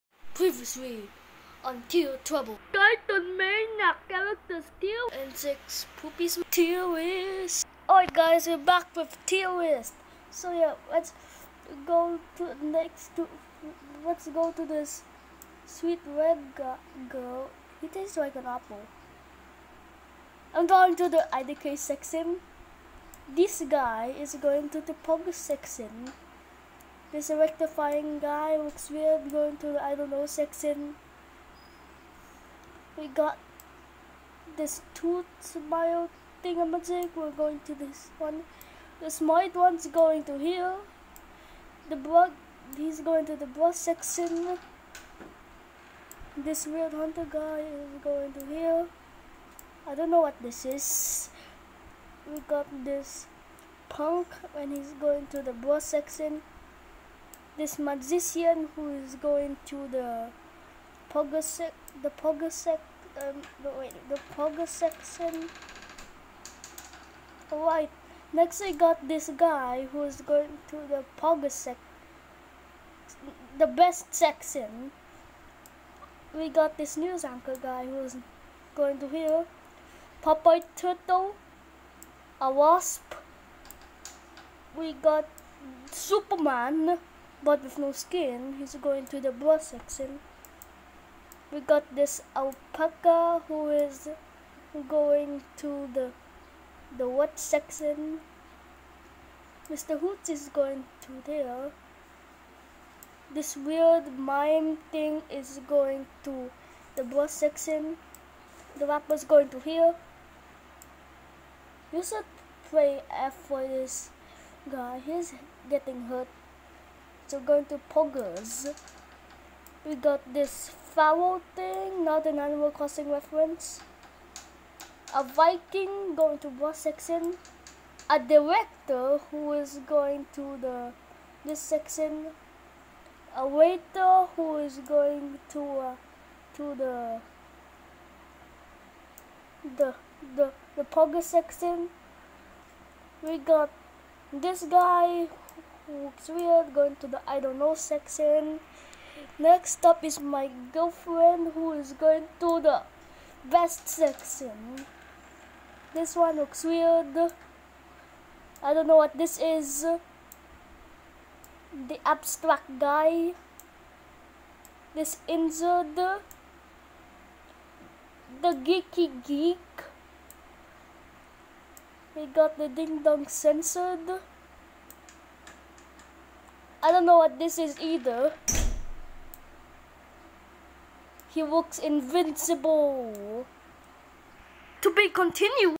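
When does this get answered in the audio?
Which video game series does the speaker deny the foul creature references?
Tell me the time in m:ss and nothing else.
2:02.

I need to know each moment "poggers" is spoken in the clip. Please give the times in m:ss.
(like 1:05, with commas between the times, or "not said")
1:57, 2:20.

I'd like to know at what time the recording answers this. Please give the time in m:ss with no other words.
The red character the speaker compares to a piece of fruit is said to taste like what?
0:18.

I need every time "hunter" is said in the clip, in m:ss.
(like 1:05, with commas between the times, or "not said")
0:46.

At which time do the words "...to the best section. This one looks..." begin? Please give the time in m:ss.
2:32.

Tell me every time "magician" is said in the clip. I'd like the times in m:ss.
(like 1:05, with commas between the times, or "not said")
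0:57.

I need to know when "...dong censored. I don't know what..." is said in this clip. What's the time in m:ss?
2:53.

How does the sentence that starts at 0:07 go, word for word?
Alright guys, we're back with Tier list.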